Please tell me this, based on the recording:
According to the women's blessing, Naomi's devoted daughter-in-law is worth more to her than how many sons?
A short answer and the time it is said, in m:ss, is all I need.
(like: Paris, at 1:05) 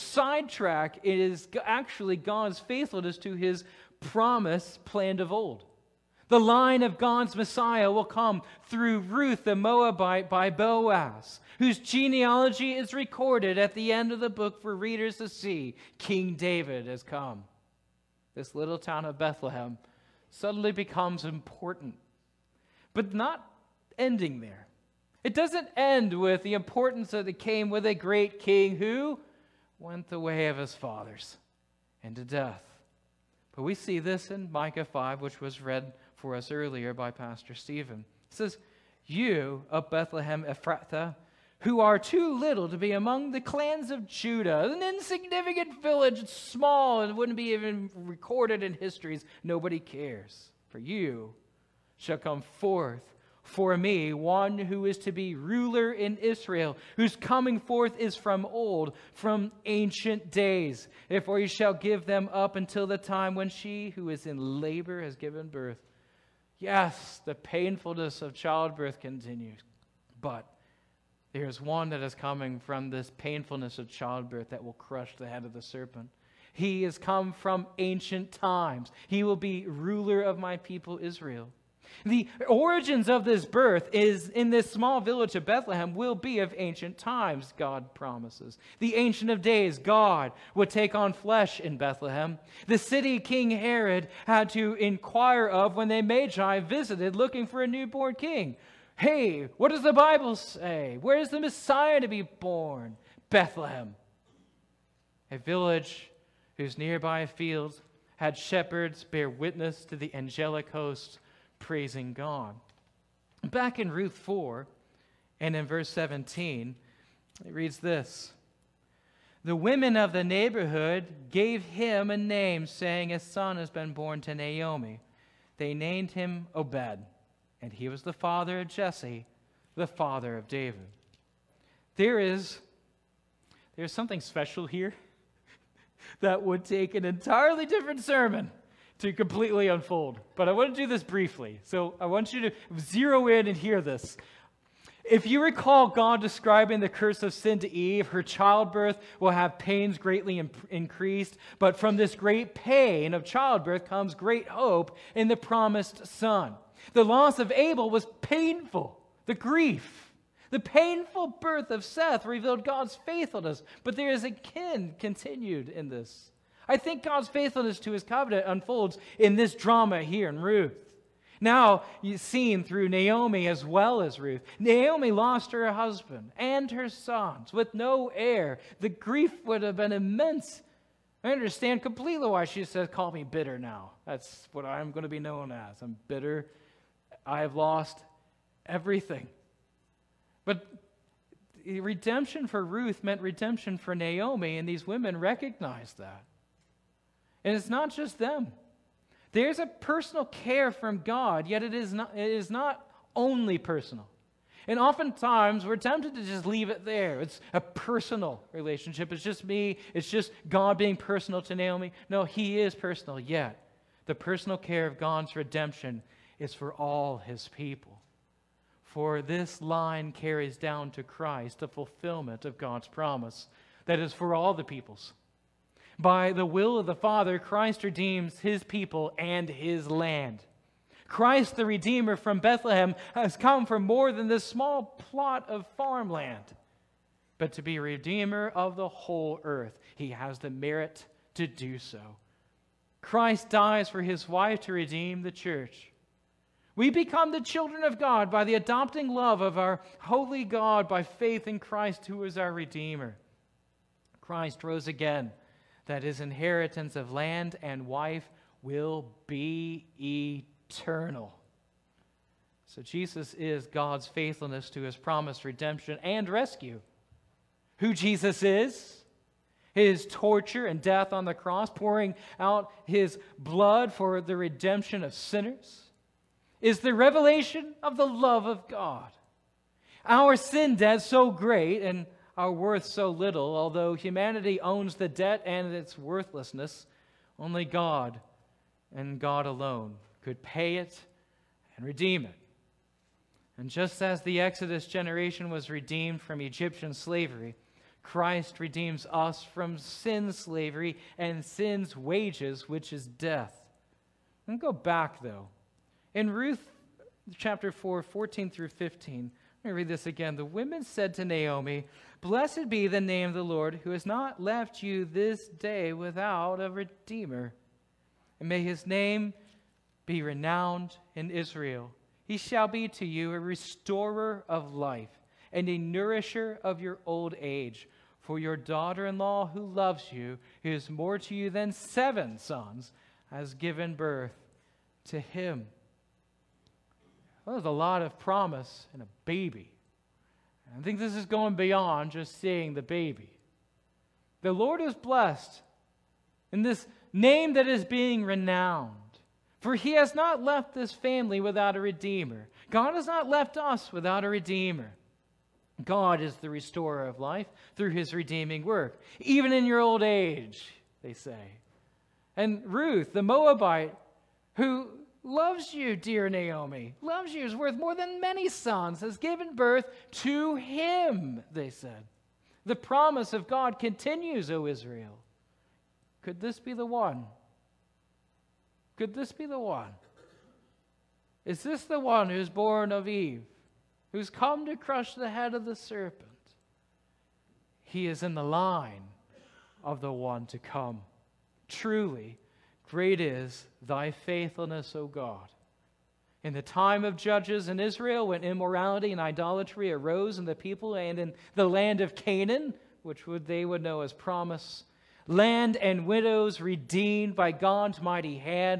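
7, at 5:31.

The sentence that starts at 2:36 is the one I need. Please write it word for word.
The loss of Abel was painful, the grief.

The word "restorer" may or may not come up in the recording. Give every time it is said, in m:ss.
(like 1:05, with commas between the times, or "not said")
5:23, 5:56.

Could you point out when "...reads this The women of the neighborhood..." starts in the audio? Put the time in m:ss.
1:57.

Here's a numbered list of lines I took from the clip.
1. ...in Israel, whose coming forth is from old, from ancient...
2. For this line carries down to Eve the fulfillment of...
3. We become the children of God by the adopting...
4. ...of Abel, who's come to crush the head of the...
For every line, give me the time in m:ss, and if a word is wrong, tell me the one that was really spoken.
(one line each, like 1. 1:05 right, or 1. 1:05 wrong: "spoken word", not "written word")
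1. 0:55 right
2. 3:38 wrong: "Christ", not "Eve"
3. 4:06 right
4. 6:22 wrong: "Eve", not "Abel".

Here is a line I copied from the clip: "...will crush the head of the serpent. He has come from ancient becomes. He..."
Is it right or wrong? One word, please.
wrong.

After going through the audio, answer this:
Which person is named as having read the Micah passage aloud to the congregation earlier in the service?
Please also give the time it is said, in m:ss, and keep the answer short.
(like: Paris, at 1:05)
Pastor Stephen, at 0:37.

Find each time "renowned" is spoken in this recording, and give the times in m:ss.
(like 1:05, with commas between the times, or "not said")
5:20, 5:48.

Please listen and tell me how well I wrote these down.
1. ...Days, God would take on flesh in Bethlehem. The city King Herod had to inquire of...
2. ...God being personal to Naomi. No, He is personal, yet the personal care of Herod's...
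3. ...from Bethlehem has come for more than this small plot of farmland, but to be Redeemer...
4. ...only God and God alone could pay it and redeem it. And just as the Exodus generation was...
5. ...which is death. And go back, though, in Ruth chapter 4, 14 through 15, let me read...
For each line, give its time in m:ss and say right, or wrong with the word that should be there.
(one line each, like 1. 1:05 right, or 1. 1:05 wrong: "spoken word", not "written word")
1. 1:29 right
2. 3:30 wrong: "God", not "Herod"
3. 3:52 right
4. 4:47 right
5. 5:02 right.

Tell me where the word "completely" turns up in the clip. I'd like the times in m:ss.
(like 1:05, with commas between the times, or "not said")
2:19, 3:01.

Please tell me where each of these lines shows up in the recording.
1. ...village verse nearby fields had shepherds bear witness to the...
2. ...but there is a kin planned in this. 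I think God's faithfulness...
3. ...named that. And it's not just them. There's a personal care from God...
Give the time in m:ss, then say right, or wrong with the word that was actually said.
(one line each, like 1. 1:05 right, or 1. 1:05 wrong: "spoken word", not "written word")
1. 1:45 wrong: "whose", not "verse"
2. 2:43 wrong: "continued", not "planned"
3. 3:15 wrong: "recognized", not "named".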